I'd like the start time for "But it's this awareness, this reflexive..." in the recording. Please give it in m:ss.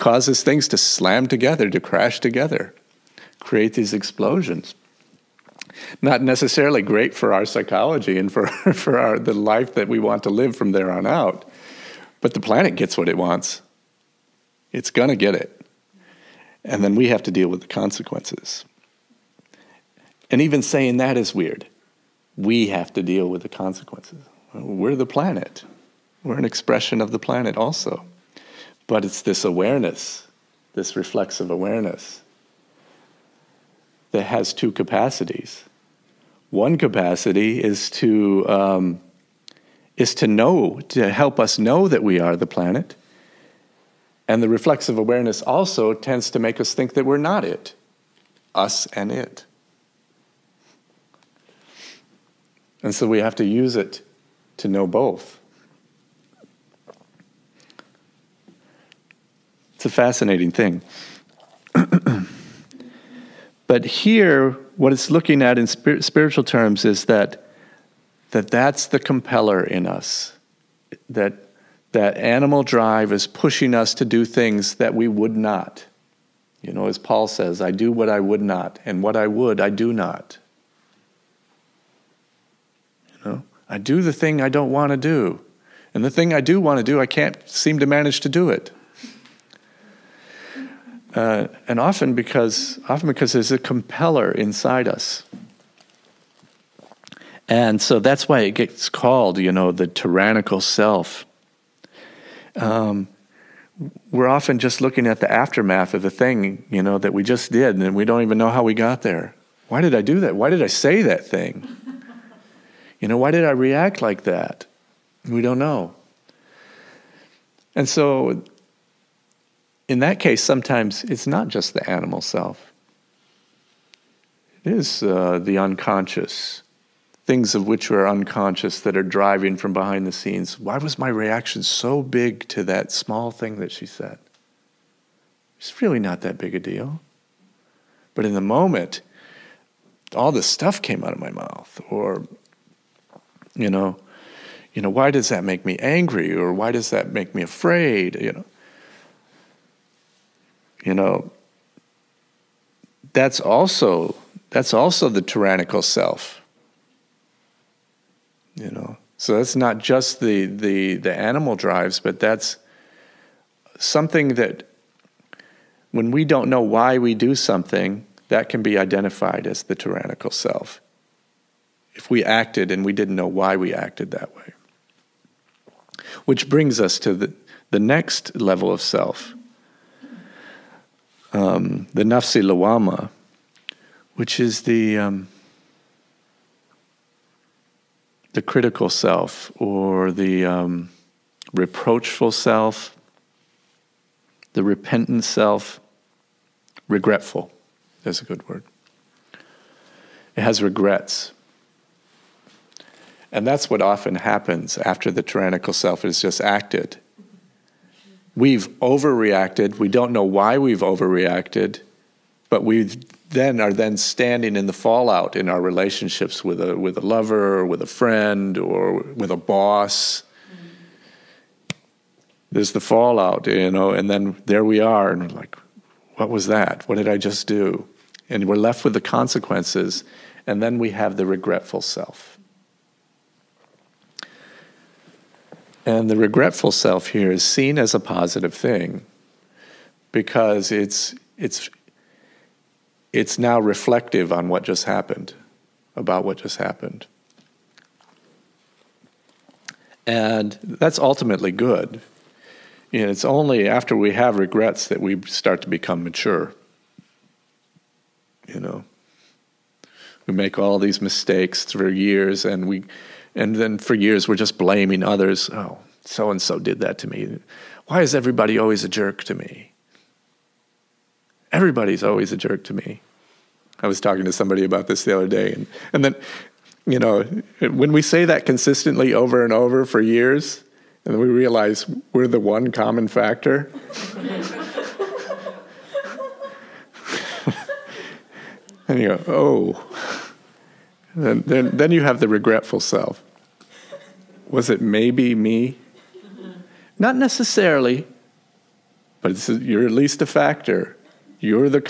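0:28.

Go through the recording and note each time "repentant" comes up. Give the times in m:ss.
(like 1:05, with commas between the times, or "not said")
3:14.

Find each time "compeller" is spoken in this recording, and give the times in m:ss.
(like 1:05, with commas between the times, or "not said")
1:08, 1:33.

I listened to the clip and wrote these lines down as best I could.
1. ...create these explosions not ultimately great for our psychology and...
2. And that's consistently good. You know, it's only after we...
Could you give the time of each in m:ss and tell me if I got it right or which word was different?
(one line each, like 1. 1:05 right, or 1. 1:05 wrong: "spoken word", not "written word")
1. 0:03 wrong: "necessarily", not "ultimately"
2. 4:10 wrong: "ultimately", not "consistently".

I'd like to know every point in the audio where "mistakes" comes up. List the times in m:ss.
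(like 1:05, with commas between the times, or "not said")
4:21.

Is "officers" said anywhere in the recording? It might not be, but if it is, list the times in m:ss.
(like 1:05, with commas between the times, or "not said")
not said.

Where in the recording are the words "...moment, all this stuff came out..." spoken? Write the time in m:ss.
2:18.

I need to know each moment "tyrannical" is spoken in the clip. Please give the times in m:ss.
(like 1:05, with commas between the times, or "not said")
1:39, 2:35, 2:49, 3:25.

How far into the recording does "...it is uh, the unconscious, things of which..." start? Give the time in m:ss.
2:04.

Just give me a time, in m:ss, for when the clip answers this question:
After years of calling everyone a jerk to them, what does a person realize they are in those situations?
4:42.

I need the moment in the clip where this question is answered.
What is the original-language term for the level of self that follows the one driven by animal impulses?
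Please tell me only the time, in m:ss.
3:02.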